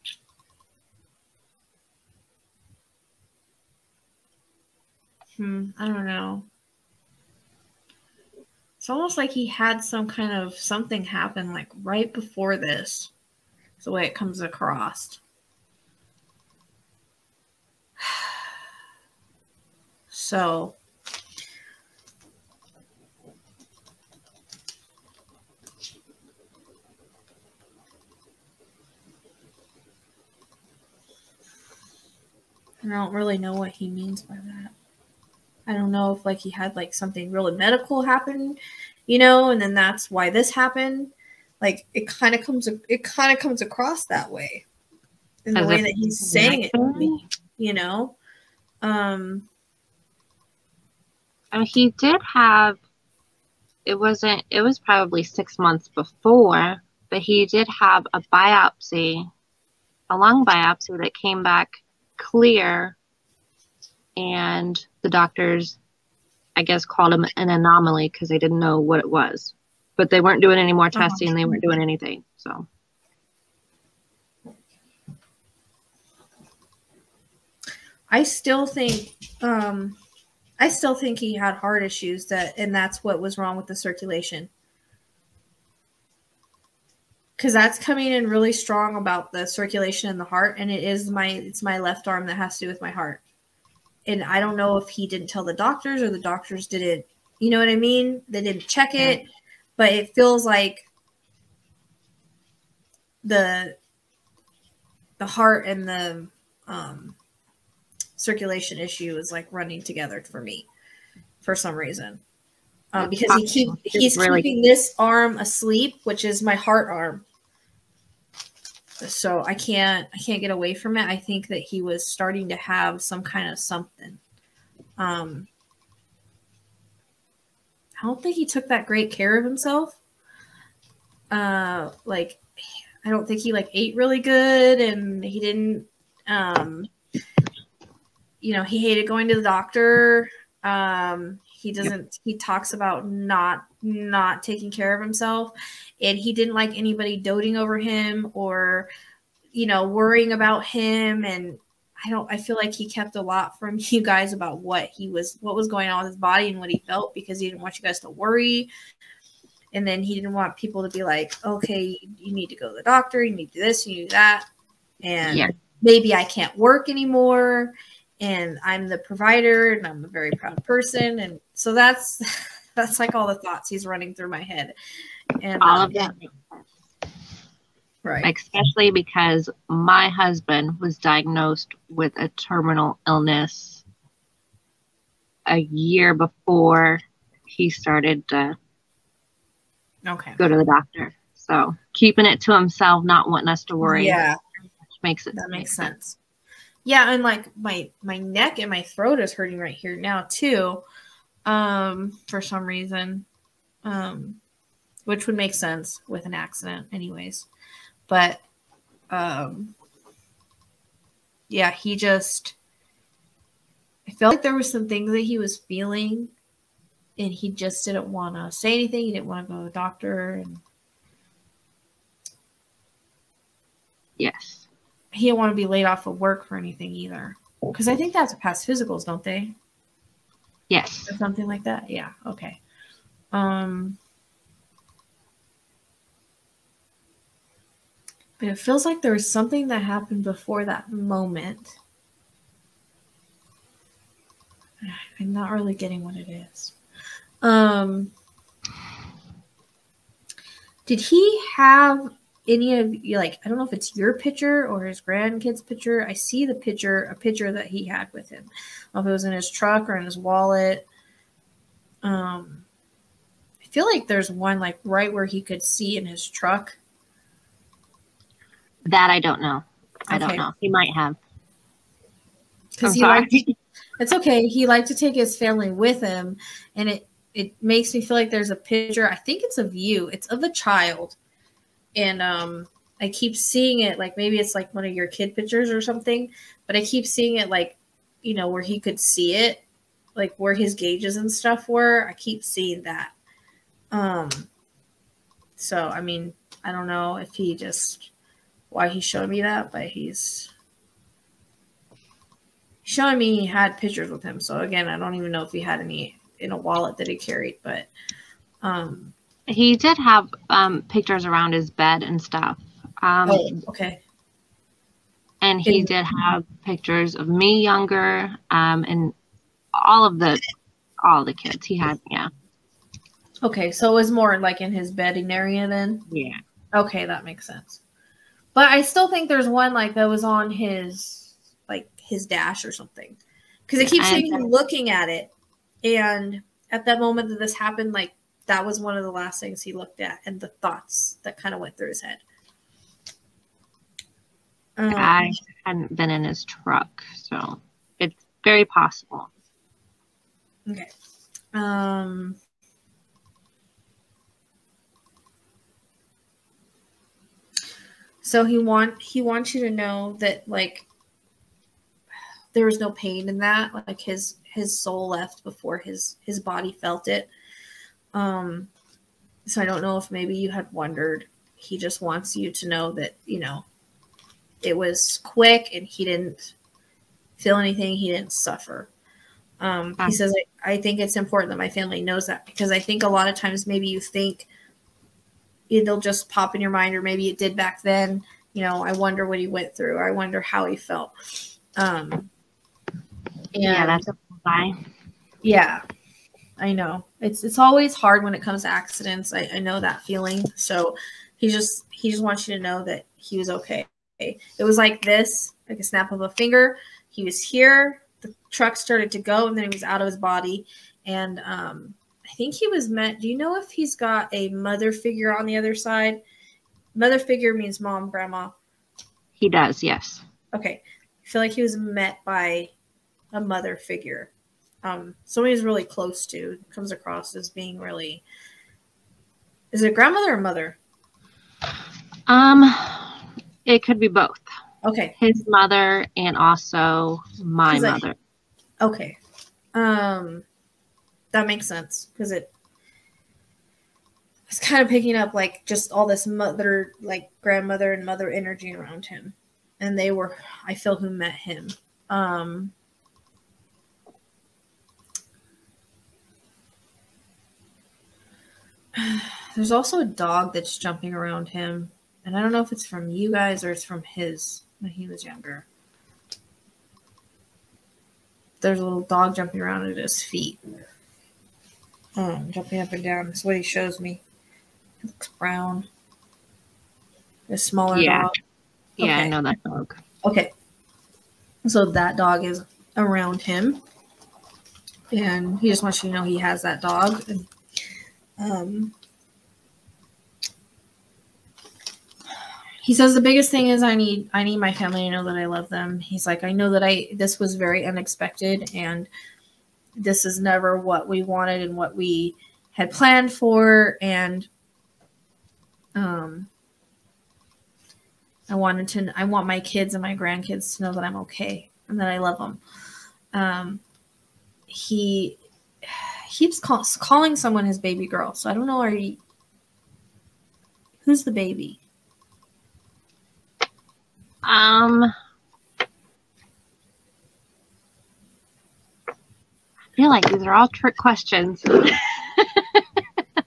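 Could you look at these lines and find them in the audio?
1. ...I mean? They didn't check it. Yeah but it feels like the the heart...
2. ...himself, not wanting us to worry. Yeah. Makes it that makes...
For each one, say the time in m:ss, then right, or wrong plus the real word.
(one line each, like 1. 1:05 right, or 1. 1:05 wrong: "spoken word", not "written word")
1. 1:37 right
2. 3:12 right.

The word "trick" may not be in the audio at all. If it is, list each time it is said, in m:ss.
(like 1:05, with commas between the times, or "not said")
8:50.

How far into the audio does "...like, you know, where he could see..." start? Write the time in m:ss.
4:47.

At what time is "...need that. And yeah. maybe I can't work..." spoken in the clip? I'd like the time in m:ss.
2:43.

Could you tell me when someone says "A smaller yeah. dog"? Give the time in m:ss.
7:57.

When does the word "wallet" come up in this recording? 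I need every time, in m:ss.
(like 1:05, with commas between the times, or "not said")
4:20, 5:06.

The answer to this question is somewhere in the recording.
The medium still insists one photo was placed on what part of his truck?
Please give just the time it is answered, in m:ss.
5:32.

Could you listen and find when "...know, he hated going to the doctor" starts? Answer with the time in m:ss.
2:18.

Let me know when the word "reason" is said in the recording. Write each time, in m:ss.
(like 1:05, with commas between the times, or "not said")
1:51, 3:22.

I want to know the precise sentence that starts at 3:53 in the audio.
Um, But it feels like there was something that happened before that moment.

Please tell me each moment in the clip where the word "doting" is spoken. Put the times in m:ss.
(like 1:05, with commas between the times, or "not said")
2:27.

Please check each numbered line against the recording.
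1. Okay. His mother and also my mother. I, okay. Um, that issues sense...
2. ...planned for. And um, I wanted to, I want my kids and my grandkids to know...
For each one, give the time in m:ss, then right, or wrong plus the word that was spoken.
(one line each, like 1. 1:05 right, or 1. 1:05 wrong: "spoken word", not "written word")
1. 7:14 wrong: "makes", not "issues"
2. 8:22 right.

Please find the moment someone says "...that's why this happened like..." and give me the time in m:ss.
0:39.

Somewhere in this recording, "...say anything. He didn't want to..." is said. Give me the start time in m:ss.
3:38.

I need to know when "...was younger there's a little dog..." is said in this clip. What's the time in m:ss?
7:45.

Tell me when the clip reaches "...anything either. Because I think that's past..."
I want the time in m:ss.
3:46.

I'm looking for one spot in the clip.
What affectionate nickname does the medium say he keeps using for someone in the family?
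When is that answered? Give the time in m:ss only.
8:37.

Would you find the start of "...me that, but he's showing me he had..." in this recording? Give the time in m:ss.
4:59.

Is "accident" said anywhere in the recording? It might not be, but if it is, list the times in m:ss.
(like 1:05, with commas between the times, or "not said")
3:26, 6:38.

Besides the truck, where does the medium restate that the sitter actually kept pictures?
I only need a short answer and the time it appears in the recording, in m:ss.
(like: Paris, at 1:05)
his bedding area, at 5:24.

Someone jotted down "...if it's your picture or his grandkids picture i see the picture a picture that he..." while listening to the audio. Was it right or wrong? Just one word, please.
right.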